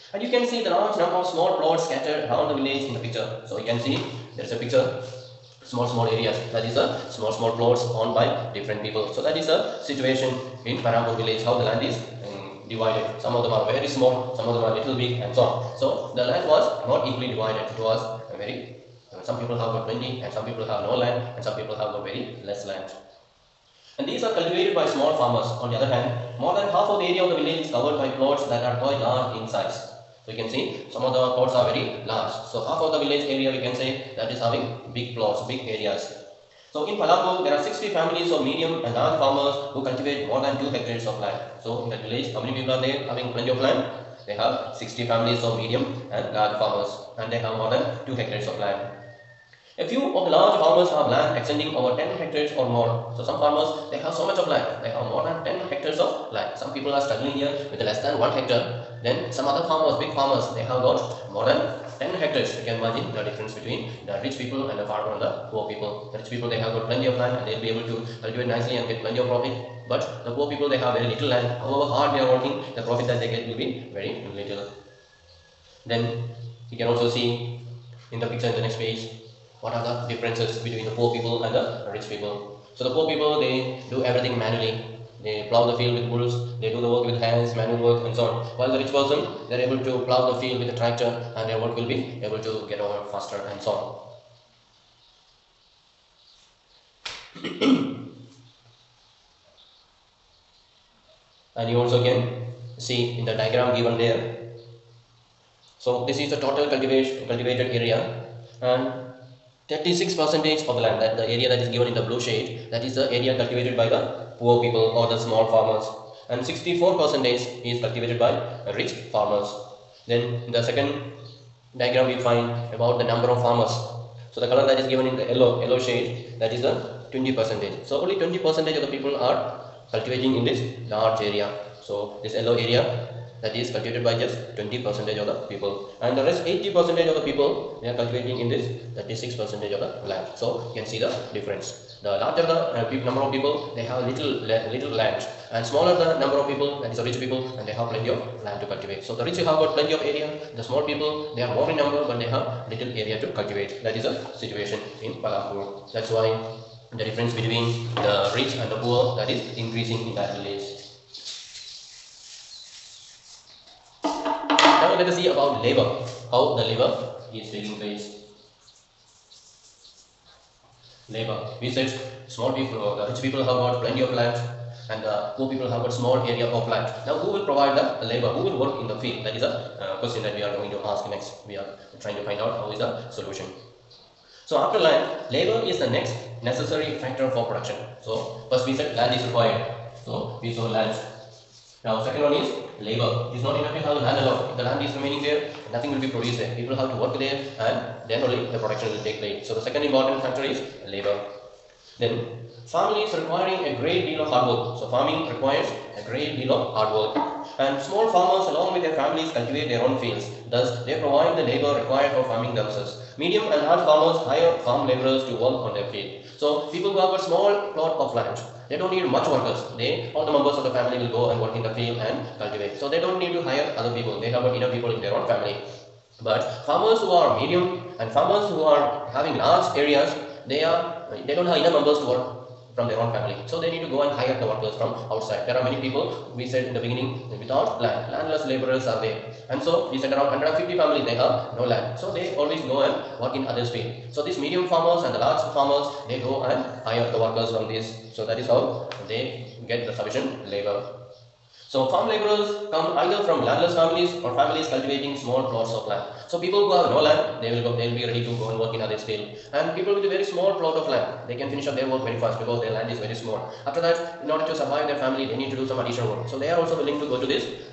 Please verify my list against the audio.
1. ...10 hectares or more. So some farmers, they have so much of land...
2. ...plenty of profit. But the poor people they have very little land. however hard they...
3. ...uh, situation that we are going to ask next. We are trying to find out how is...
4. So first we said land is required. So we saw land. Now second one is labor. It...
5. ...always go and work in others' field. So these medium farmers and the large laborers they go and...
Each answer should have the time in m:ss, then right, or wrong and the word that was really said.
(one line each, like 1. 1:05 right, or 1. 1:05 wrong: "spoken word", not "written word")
1. 0:51 right
2. 1:09 right
3. 2:59 wrong: "question", not "situation"
4. 3:08 right
5. 4:02 wrong: "farmers", not "laborers".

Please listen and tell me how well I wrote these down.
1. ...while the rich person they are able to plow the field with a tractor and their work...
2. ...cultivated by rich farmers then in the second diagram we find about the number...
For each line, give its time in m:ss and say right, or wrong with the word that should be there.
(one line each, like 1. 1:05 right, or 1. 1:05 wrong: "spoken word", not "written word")
1. 1:28 right
2. 1:57 right.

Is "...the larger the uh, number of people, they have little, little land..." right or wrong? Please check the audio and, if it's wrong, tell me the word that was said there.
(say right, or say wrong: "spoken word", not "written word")
right.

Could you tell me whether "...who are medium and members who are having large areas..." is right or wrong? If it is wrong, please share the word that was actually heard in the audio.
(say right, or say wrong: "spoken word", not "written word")
wrong: "farmers", not "members".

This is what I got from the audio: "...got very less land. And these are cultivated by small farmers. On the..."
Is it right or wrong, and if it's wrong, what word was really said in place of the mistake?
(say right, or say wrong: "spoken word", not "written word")
right.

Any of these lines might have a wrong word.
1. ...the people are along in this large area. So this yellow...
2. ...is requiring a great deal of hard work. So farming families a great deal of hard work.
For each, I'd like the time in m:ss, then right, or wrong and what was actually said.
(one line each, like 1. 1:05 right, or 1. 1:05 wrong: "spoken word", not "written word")
1. 2:08 wrong: "cultivating", not "along"
2. 3:23 wrong: "requires", not "families".